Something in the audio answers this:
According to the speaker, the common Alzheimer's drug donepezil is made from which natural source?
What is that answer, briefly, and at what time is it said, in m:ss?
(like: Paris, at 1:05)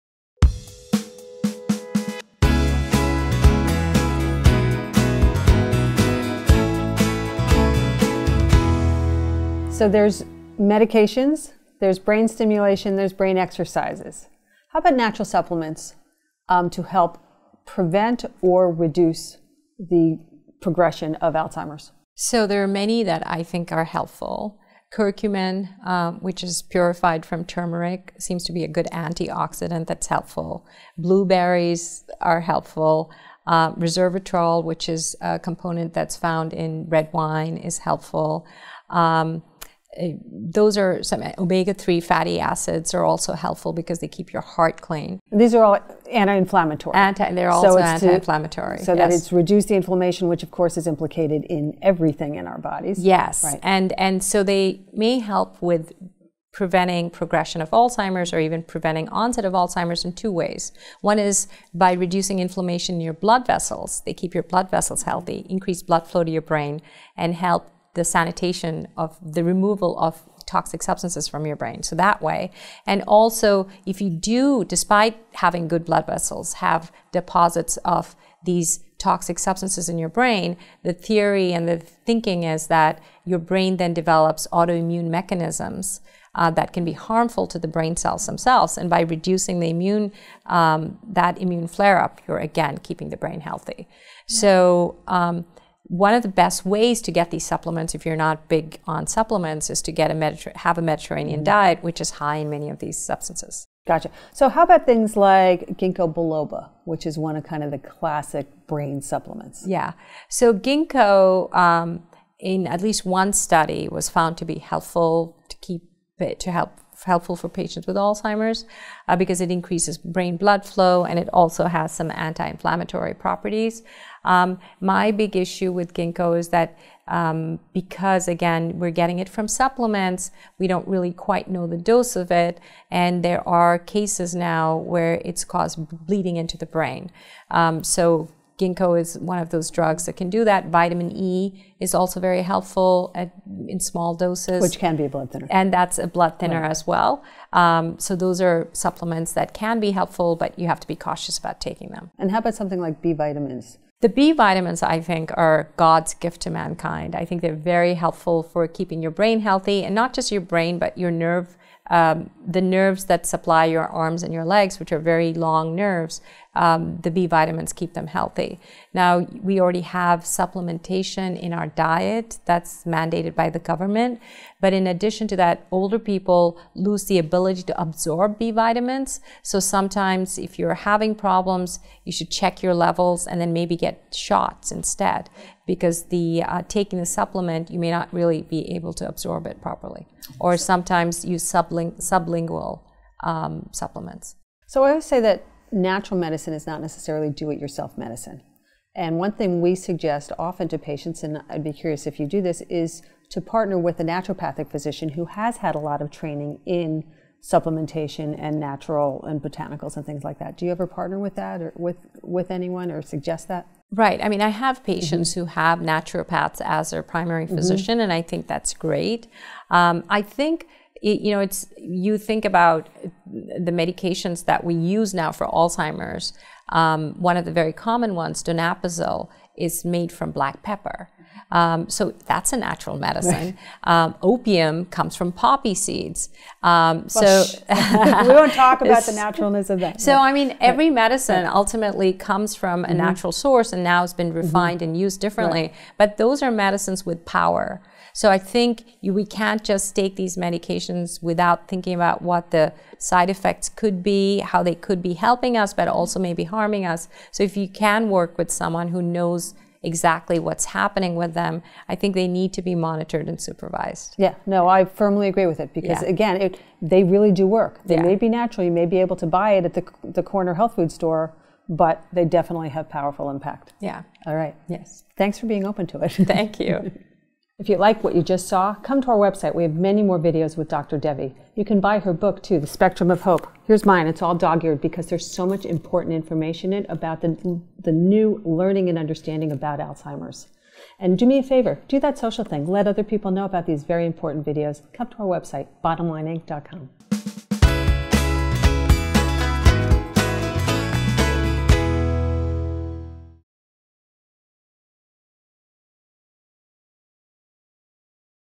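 Black pepper, at 3:50.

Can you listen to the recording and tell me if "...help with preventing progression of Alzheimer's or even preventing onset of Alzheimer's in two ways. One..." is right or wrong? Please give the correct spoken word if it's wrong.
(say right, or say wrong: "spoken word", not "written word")
right.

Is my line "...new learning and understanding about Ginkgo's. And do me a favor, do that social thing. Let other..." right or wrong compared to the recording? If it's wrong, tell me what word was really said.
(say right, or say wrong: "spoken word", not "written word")
wrong: "Alzheimer", not "Ginkgo".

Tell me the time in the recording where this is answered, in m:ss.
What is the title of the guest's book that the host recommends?
4:42.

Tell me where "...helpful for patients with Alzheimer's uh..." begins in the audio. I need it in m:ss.
1:57.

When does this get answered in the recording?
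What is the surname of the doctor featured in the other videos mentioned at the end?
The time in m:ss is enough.
4:40.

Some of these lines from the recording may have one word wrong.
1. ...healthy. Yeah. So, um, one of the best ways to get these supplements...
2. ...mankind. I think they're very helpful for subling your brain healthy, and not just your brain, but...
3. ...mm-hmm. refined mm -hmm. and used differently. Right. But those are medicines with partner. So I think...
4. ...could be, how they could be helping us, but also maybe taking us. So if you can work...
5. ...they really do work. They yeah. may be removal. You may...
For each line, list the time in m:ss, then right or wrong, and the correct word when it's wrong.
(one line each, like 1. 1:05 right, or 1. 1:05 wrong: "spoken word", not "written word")
1. 1:33 right
2. 2:36 wrong: "keeping", not "subling"
3. 4:04 wrong: "power", not "partner"
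4. 4:13 wrong: "harming", not "taking"
5. 4:26 wrong: "natural", not "removal".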